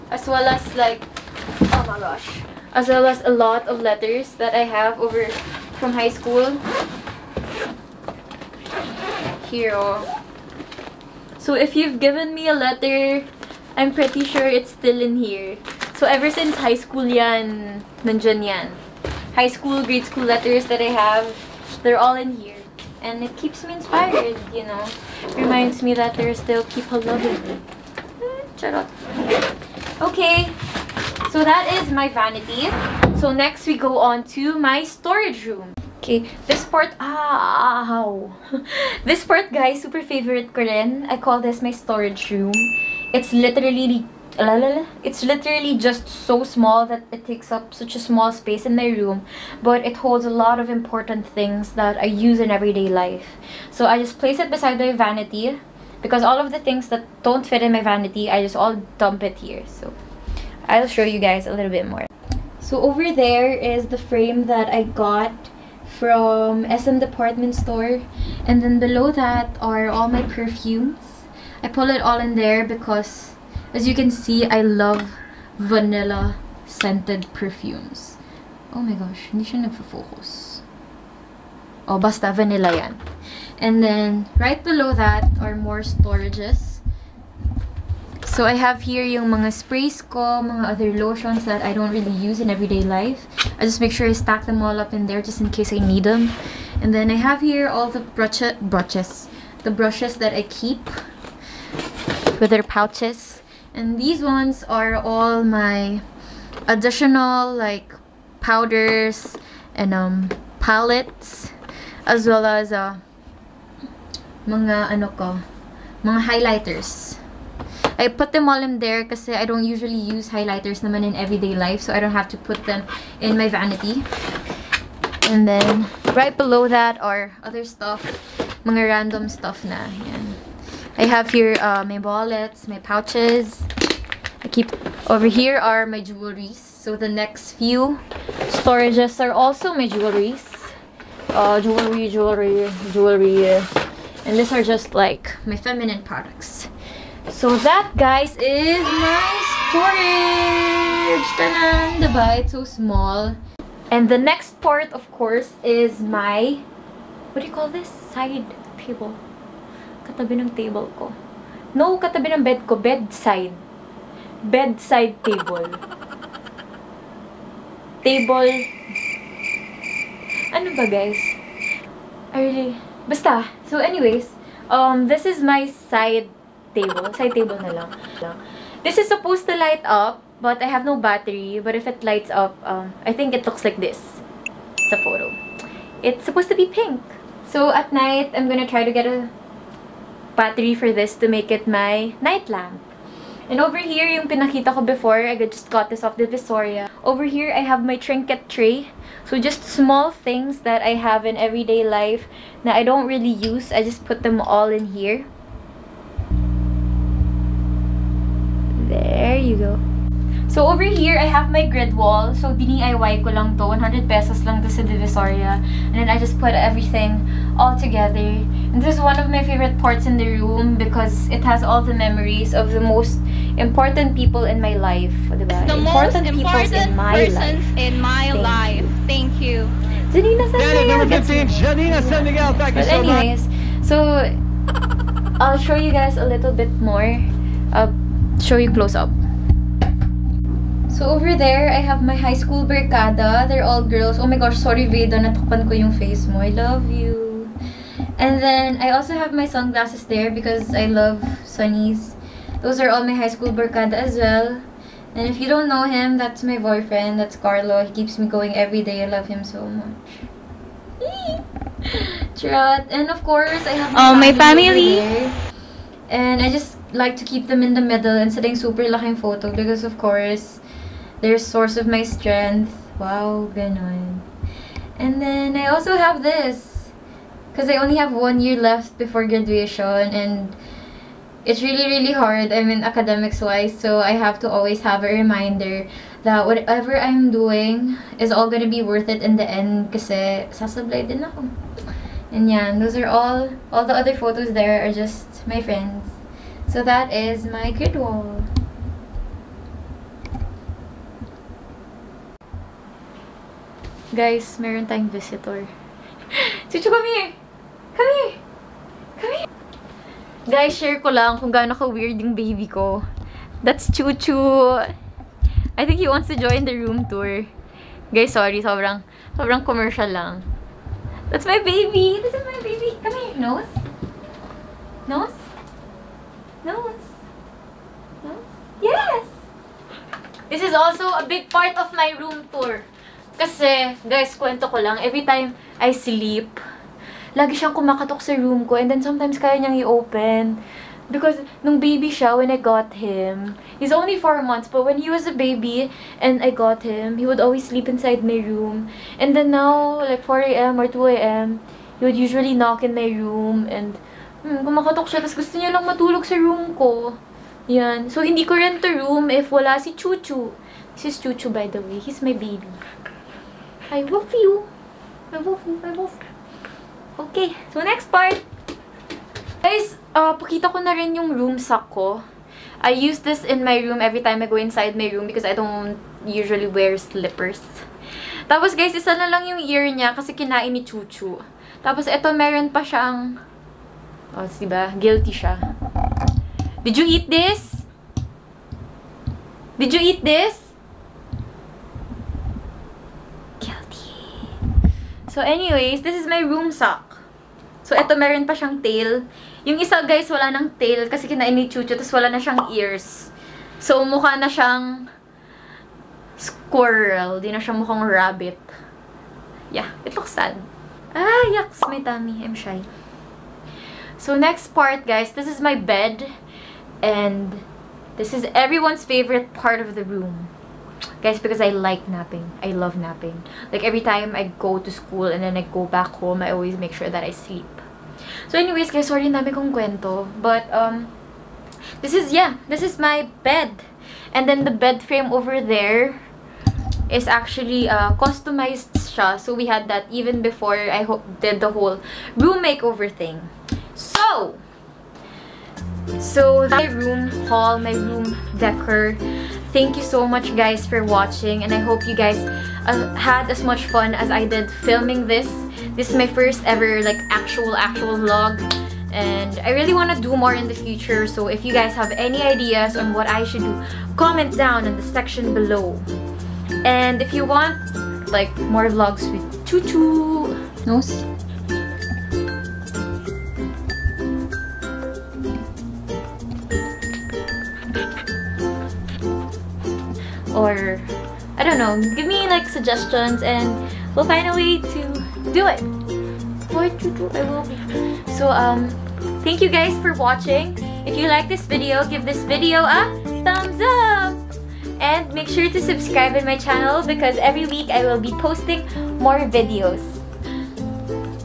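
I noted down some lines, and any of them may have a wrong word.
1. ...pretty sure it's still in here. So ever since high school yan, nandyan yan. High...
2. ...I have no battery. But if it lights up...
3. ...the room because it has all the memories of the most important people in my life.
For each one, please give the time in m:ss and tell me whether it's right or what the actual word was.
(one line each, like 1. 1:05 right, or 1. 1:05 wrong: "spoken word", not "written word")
1. 0:13 right
2. 3:00 right
3. 3:40 right.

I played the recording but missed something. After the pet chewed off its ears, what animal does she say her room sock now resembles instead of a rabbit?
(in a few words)
Squirrel.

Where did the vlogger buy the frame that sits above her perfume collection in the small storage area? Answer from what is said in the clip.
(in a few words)
SM department store.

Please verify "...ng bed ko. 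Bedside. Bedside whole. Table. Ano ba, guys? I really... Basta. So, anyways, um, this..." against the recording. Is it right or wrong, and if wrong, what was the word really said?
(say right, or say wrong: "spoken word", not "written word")
wrong: "table", not "whole".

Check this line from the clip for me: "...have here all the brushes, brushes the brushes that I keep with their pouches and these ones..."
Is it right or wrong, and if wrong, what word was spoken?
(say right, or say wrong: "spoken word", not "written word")
right.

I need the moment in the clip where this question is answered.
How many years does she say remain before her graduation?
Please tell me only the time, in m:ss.
4:38.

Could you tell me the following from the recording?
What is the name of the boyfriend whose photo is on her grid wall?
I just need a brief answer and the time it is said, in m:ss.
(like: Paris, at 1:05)
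Carlo, at 4:17.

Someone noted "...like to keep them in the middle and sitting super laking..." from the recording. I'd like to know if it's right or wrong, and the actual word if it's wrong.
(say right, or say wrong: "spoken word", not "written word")
right.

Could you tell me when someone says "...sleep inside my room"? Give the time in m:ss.
5:47.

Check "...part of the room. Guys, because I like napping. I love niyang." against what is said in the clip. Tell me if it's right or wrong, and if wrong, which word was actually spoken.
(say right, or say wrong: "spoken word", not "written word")
wrong: "napping", not "niyang".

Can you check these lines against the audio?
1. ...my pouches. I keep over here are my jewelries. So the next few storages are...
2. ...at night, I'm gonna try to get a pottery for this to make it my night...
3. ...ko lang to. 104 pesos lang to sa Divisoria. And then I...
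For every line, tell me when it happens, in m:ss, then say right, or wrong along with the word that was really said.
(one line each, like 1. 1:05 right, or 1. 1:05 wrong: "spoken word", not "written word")
1. 2:12 right
2. 3:07 right
3. 3:33 wrong: "100", not "104".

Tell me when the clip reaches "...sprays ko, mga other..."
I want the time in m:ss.
1:29.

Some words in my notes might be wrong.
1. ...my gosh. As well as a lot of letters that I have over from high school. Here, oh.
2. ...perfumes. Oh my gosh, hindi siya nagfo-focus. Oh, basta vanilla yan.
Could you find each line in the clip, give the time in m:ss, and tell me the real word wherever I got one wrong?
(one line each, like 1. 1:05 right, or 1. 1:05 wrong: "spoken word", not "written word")
1. 0:01 right
2. 1:17 right.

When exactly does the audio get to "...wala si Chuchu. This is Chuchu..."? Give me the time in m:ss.
5:59.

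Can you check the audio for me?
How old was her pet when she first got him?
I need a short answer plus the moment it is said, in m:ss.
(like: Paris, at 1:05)
4 months, at 5:44.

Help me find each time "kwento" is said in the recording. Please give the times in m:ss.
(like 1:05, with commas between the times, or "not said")
5:34, 7:09.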